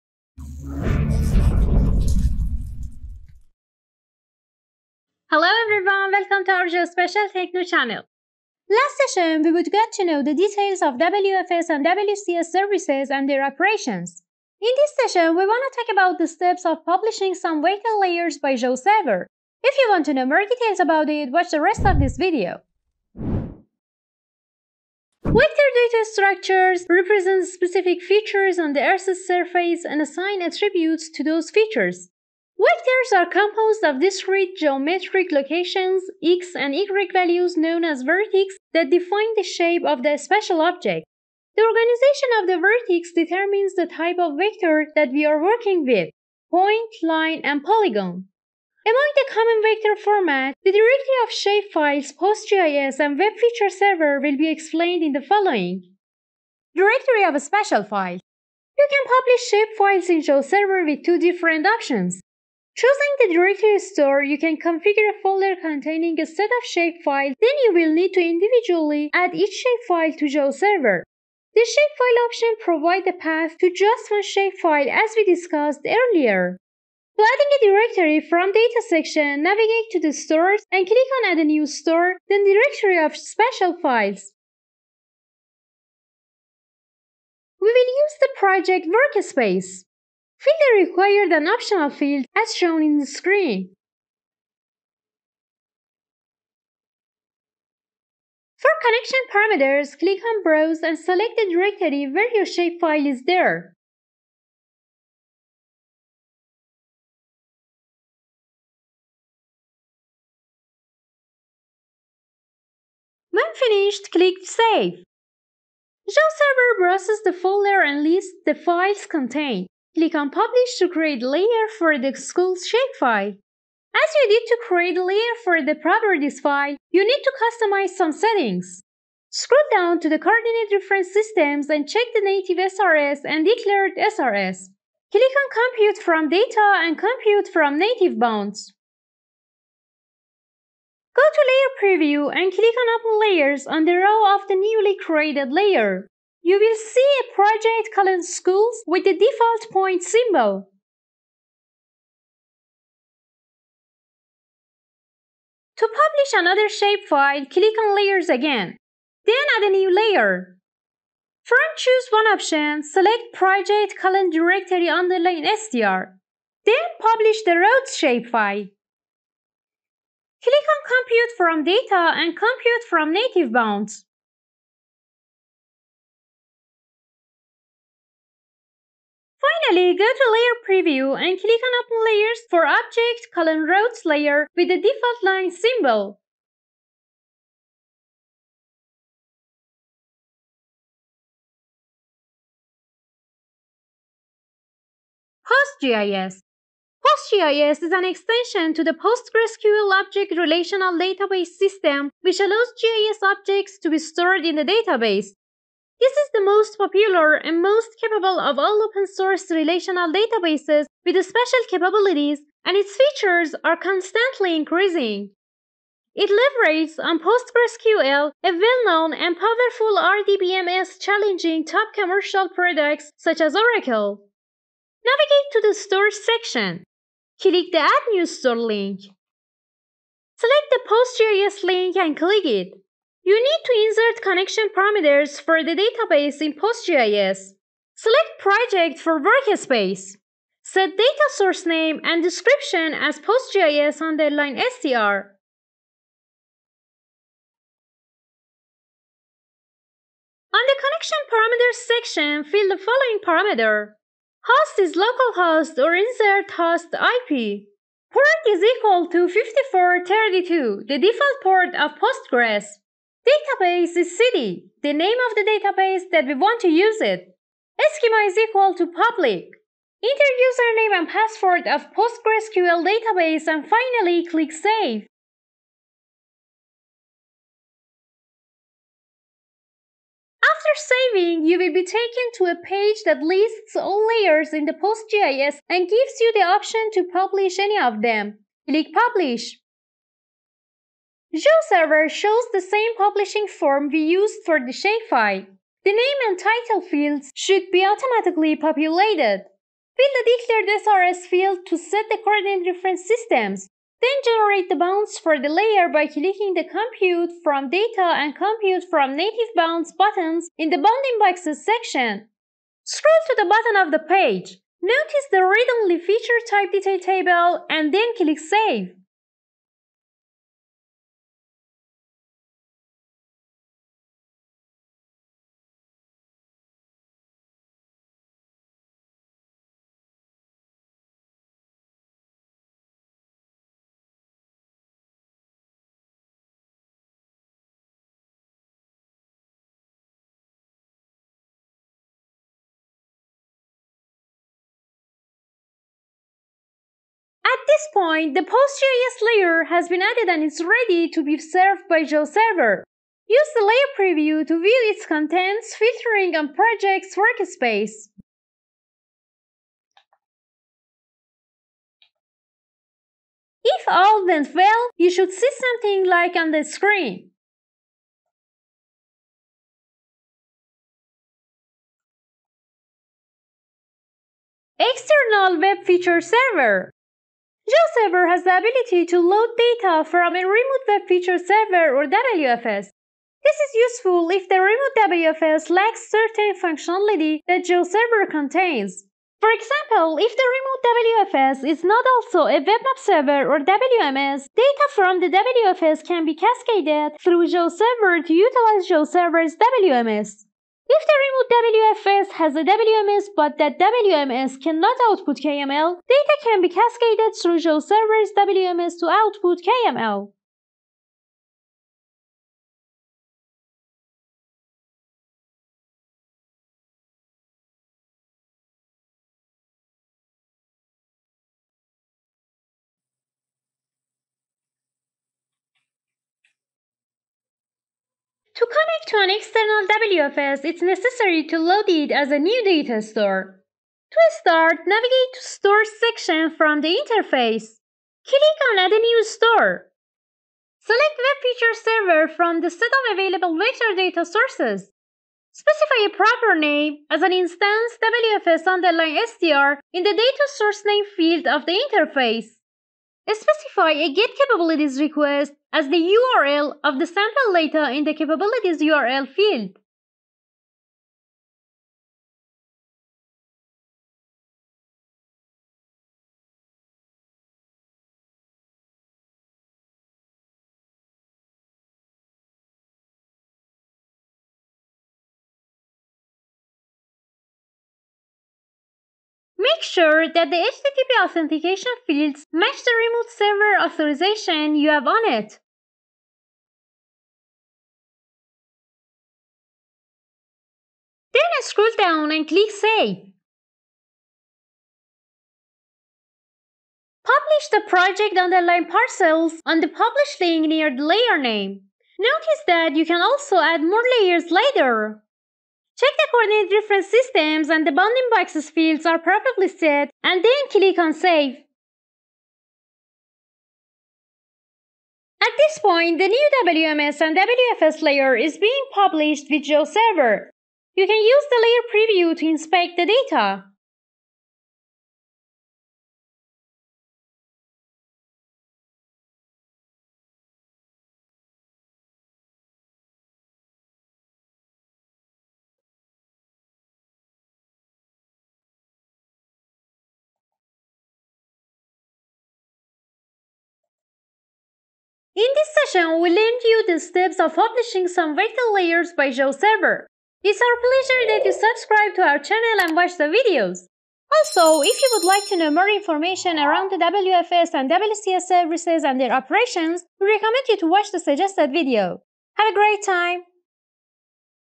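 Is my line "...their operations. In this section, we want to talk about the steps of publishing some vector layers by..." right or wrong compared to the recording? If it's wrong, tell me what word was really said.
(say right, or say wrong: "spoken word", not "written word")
wrong: "session", not "section".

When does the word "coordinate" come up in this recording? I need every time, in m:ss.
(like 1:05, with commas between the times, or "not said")
2:10, 5:02, 8:26.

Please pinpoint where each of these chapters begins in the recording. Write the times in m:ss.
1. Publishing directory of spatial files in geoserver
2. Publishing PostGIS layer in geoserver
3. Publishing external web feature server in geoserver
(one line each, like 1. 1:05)
1. 0:56
2. 3:15
3. 6:14.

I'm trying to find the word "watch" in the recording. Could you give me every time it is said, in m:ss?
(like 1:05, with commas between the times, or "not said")
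0:21, 9:12, 9:20.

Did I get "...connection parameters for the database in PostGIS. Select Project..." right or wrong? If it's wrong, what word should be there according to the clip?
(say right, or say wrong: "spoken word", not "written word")
right.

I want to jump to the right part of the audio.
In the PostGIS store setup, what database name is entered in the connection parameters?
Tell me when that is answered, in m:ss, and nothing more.
4:24.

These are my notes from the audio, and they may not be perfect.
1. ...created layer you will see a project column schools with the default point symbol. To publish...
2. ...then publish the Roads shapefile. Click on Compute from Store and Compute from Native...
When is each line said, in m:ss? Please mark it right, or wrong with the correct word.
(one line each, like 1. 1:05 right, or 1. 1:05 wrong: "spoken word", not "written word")
1. 2:24 right
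2. 2:46 wrong: "Data", not "Store".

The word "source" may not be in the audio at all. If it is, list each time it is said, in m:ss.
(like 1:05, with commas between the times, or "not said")
3:29, 4:01, 7:24, 7:30.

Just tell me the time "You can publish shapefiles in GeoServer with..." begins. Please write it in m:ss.
0:58.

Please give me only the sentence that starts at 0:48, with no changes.
Among the common vector format, the directory of shapefiles, PostGIS, and Web Feature Server will be explained in the following.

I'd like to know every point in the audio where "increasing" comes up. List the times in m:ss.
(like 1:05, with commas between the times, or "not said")
3:34.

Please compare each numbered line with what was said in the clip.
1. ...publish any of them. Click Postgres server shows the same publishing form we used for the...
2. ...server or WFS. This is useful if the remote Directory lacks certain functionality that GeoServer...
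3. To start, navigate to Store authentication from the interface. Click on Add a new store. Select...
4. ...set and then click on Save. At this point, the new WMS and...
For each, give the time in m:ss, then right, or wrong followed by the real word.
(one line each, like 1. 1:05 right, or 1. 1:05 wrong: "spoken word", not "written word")
1. 4:47 wrong: "Publish", not "Postgres"
2. 6:21 wrong: "WFS", not "Directory"
3. 7:14 wrong: "section", not "authentication"
4. 8:29 right.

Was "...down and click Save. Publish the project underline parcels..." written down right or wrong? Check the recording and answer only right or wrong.
right.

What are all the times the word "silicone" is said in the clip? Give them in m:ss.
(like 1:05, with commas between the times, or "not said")
not said.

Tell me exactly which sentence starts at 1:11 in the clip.
The shapefile option provides a path to just one shapefile as we discussed earlier.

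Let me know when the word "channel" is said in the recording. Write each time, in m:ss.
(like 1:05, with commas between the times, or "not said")
0:07, 9:12.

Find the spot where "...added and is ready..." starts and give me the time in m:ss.
5:50.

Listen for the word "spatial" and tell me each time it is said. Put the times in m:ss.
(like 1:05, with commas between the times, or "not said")
0:40, 0:57, 1:23, 3:31.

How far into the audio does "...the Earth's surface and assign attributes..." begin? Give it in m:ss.
0:28.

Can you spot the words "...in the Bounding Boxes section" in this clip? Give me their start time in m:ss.
5:10.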